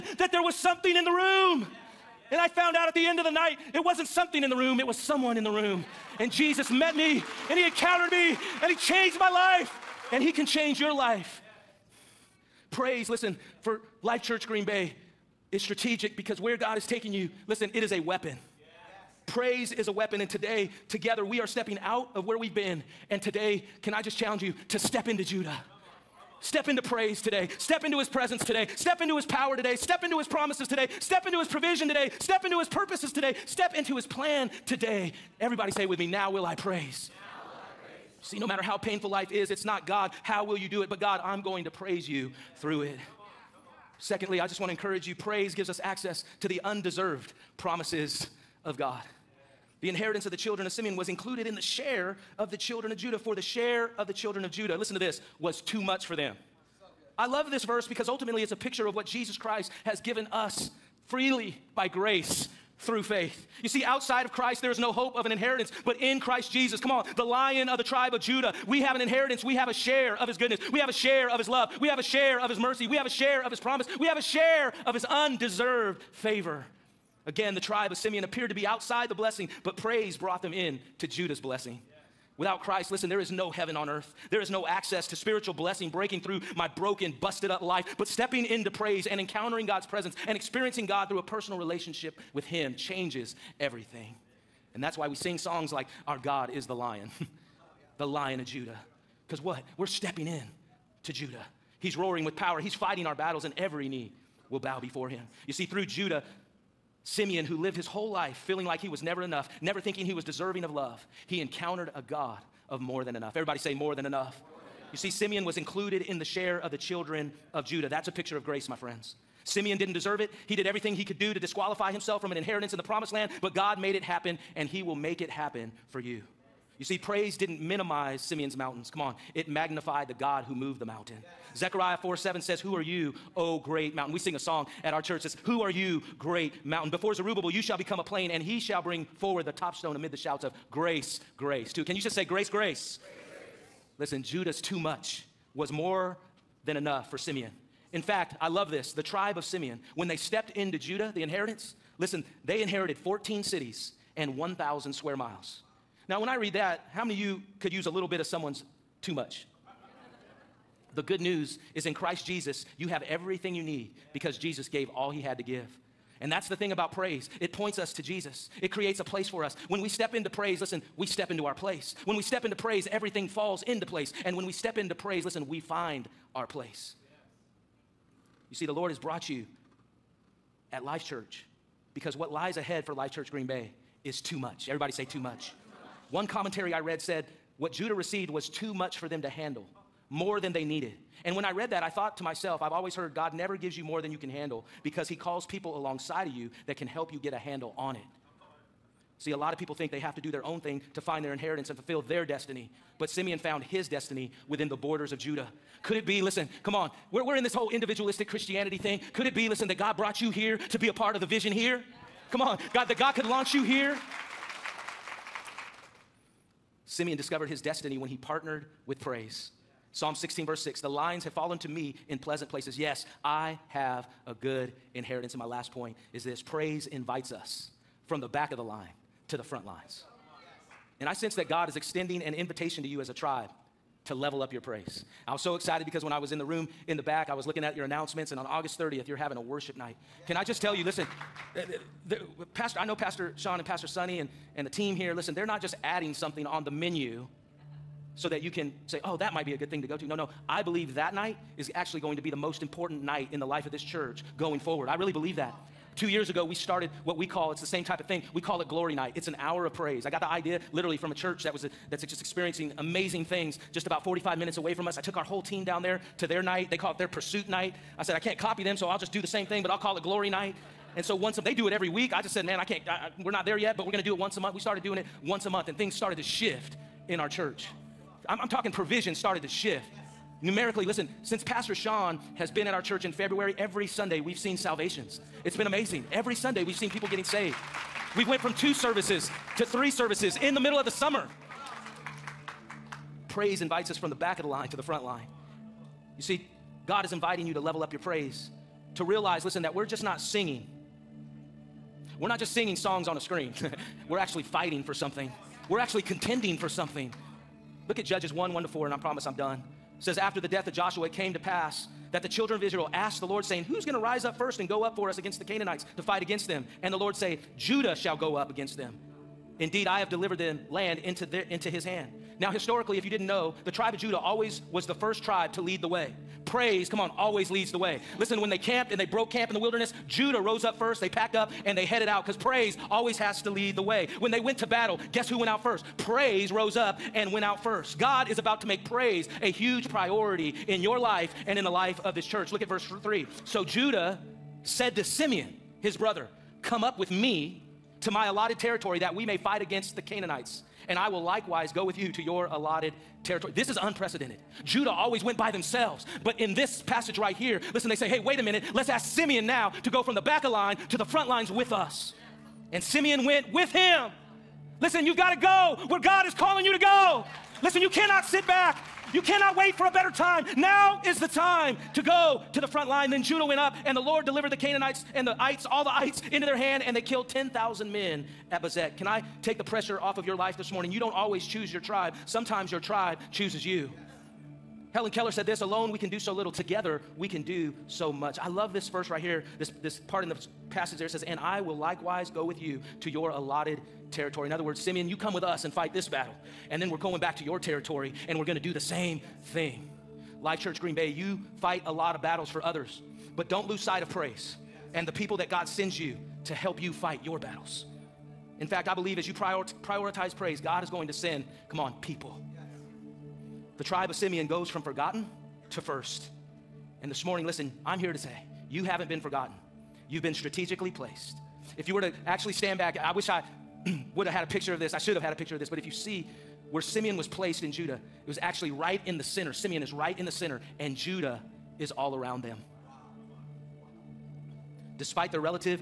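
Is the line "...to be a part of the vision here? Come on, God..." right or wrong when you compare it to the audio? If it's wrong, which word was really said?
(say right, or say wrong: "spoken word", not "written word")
right.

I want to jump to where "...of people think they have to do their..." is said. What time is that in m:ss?
3:19.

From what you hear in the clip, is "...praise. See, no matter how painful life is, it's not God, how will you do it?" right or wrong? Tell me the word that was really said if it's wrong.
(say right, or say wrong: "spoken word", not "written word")
right.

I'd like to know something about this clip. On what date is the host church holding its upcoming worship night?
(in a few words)
August 30th.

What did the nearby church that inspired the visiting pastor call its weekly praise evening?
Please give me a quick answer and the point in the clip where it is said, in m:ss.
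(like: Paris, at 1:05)
pursuit night, at 4:27.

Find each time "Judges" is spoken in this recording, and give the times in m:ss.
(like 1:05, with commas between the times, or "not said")
5:08.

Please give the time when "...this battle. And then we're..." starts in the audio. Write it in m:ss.
6:35.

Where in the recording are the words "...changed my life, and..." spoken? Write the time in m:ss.
0:08.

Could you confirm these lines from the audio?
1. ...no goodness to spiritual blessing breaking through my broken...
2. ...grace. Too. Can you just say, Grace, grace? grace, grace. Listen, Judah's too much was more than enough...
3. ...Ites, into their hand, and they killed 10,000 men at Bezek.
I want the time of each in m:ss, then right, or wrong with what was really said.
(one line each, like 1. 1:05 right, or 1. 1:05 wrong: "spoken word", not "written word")
1. 1:24 wrong: "access", not "goodness"
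2. 2:21 right
3. 6:15 right.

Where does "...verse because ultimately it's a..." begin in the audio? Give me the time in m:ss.
0:57.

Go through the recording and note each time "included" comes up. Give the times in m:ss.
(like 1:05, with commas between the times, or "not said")
0:51, 1:55.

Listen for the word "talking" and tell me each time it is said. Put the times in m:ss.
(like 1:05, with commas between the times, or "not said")
4:38.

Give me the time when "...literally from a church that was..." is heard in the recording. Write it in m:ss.
4:20.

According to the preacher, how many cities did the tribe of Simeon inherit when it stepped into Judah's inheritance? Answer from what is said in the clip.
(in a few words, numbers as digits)
14.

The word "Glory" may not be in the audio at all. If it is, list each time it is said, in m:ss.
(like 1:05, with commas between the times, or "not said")
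4:18, 4:30.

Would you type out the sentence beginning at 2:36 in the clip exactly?
Now, when I read that, how many of you could use a little bit of someone's too much?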